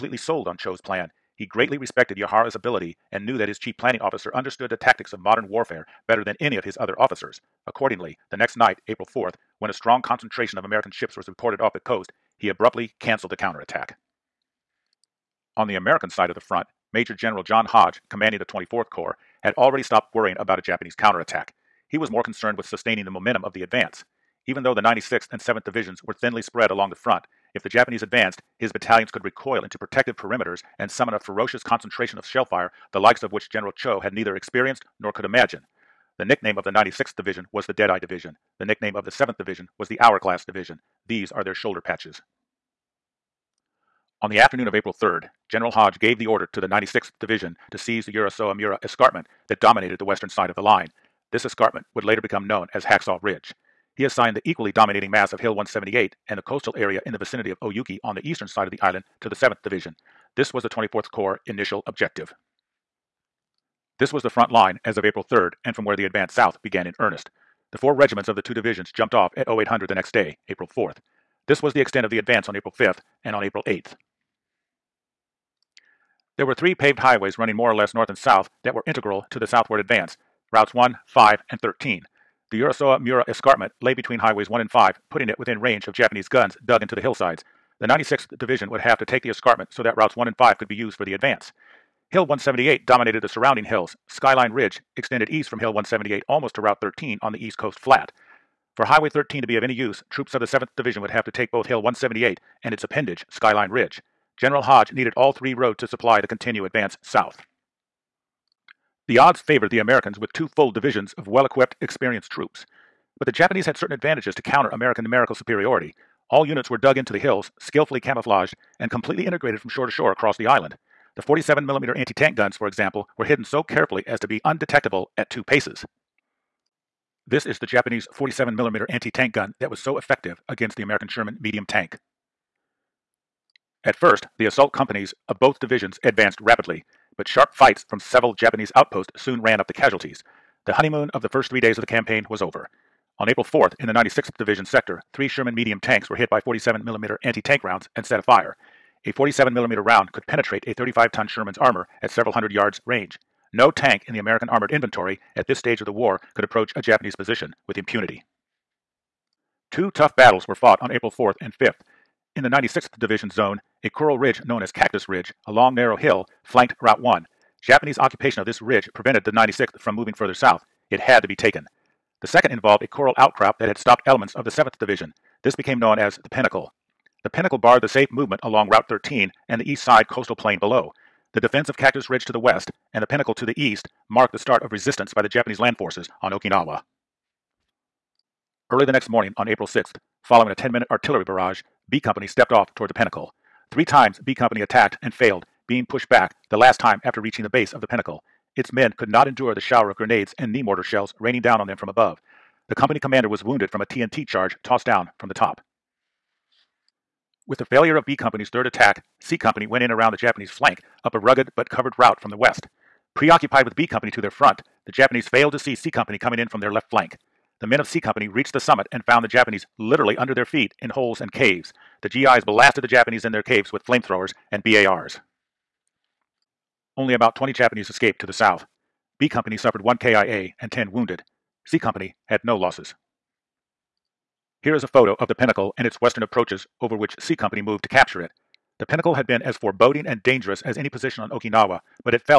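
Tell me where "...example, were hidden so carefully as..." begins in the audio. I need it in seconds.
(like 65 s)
122 s.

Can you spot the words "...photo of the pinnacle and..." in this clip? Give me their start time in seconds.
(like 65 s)
234 s.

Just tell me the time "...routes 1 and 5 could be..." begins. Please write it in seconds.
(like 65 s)
89 s.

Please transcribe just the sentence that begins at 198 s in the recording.
Its men could not endure the shower of grenades and knee mortar shells raining down on them from above.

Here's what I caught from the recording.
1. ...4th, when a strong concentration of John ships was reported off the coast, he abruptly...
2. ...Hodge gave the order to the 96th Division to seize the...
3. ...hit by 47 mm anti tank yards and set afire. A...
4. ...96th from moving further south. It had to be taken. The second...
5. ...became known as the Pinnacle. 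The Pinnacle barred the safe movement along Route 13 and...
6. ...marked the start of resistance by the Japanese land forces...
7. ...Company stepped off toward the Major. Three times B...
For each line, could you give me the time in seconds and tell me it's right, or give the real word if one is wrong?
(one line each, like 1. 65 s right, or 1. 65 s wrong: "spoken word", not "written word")
1. 9 s wrong: "American", not "John"
2. 45 s right
3. 146 s wrong: "rounds", not "yards"
4. 169 s right
5. 175 s right
6. 184 s right
7. 191 s wrong: "Pinnacle", not "Major".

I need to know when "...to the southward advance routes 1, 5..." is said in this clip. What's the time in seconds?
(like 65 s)
79 s.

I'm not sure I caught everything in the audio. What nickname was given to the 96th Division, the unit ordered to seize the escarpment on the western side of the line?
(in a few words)
Deadeye Division.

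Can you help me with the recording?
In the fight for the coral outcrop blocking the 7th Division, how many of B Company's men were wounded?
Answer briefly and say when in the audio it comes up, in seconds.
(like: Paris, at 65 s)
10, at 230 s.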